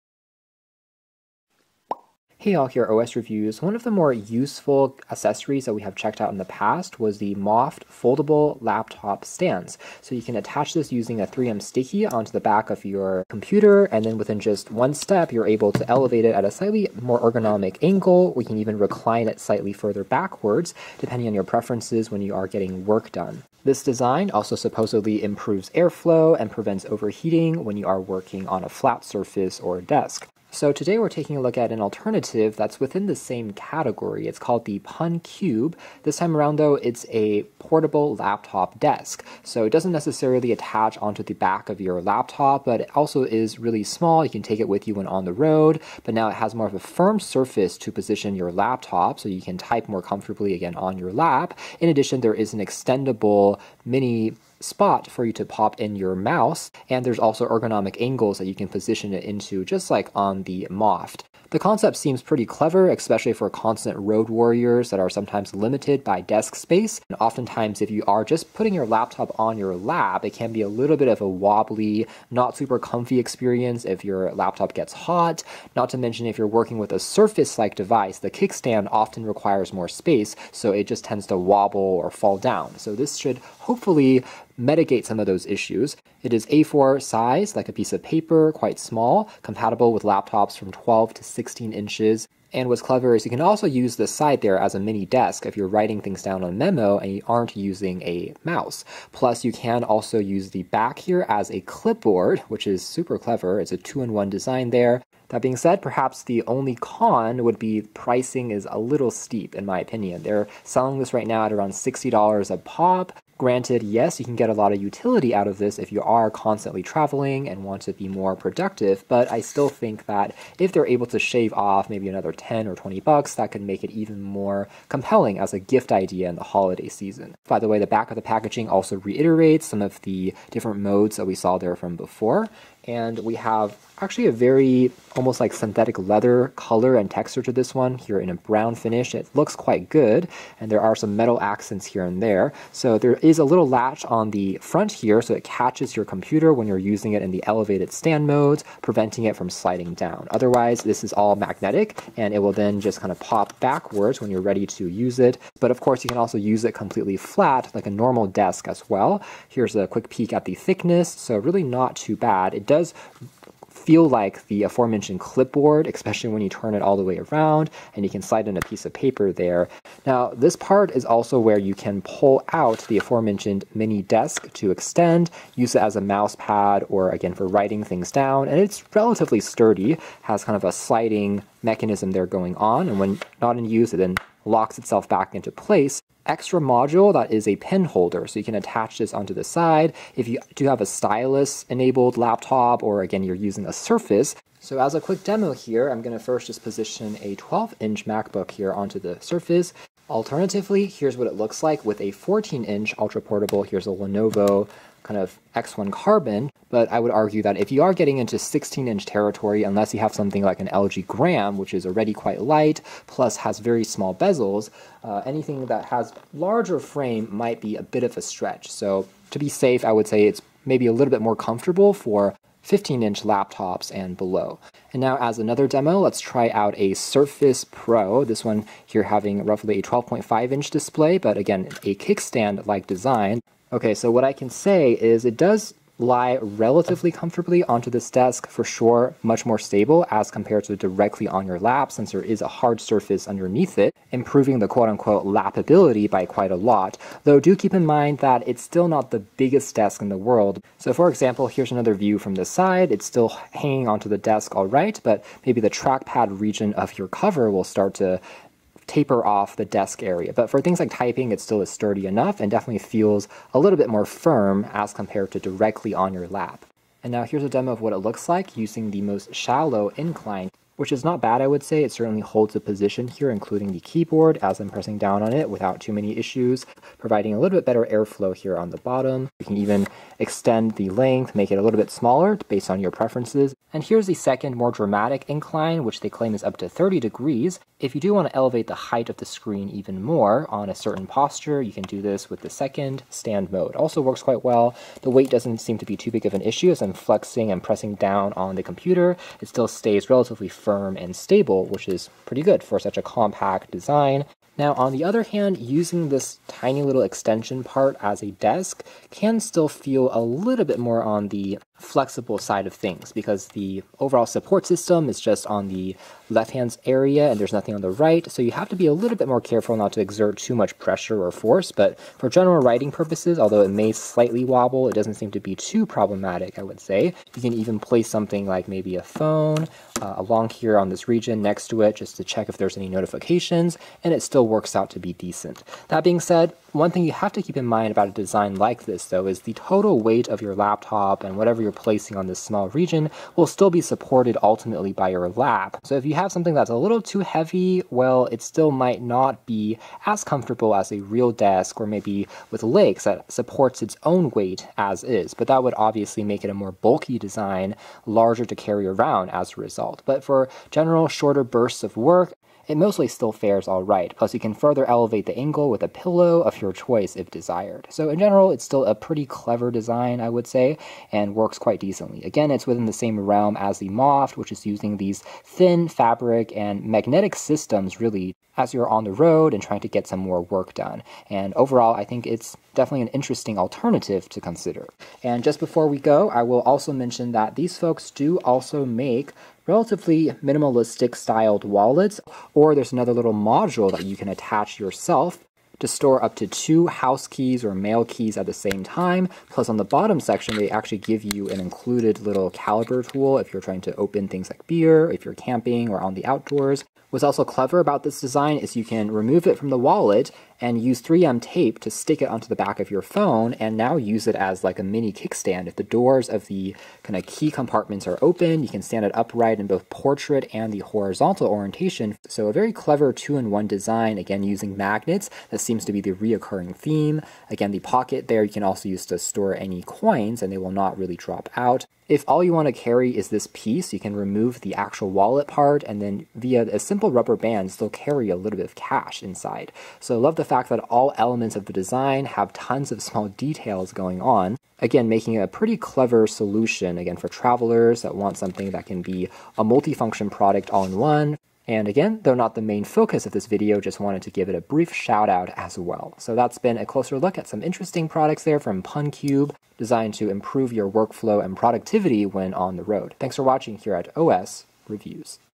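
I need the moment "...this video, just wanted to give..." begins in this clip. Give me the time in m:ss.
7:33.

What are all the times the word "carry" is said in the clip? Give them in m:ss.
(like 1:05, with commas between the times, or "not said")
5:58, 7:12, 7:17.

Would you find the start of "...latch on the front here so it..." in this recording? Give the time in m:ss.
2:23.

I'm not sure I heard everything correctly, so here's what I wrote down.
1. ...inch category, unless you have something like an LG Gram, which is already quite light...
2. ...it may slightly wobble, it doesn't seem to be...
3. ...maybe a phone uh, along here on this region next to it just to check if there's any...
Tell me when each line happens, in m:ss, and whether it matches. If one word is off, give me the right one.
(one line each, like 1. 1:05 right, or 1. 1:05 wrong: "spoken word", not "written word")
1. 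3:28 wrong: "territory", not "category"
2. 5:23 right
3. 5:28 right.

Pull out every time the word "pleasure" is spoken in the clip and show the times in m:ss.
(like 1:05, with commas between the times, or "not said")
not said.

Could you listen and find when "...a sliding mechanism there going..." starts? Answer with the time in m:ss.
3:00.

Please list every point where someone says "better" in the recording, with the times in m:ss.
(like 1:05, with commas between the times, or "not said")
4:37.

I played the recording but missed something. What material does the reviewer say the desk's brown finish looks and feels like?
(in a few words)
synthetic leather.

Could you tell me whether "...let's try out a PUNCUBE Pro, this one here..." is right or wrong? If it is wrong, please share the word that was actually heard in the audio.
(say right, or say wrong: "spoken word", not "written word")
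wrong: "Surface", not "PUNCUBE".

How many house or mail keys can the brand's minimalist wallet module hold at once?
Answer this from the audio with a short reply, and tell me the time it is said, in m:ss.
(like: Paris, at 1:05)
2, at 6:36.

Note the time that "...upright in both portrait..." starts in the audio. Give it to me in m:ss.
6:59.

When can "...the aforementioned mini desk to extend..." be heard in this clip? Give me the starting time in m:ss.
2:52.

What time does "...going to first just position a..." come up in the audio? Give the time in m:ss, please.
3:16.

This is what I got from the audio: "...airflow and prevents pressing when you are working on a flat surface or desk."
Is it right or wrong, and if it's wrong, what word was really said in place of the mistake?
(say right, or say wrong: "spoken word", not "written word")
wrong: "overheating", not "pressing".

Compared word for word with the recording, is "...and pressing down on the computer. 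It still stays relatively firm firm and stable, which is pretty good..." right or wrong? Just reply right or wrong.
right.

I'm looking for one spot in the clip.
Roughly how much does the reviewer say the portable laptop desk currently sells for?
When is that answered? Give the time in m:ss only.
1:51.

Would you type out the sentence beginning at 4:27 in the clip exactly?
And now here's a demo of what it looks like using the most shallow incline which is not bad, I would say.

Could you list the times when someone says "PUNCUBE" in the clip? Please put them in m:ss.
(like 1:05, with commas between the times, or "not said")
0:34, 7:38.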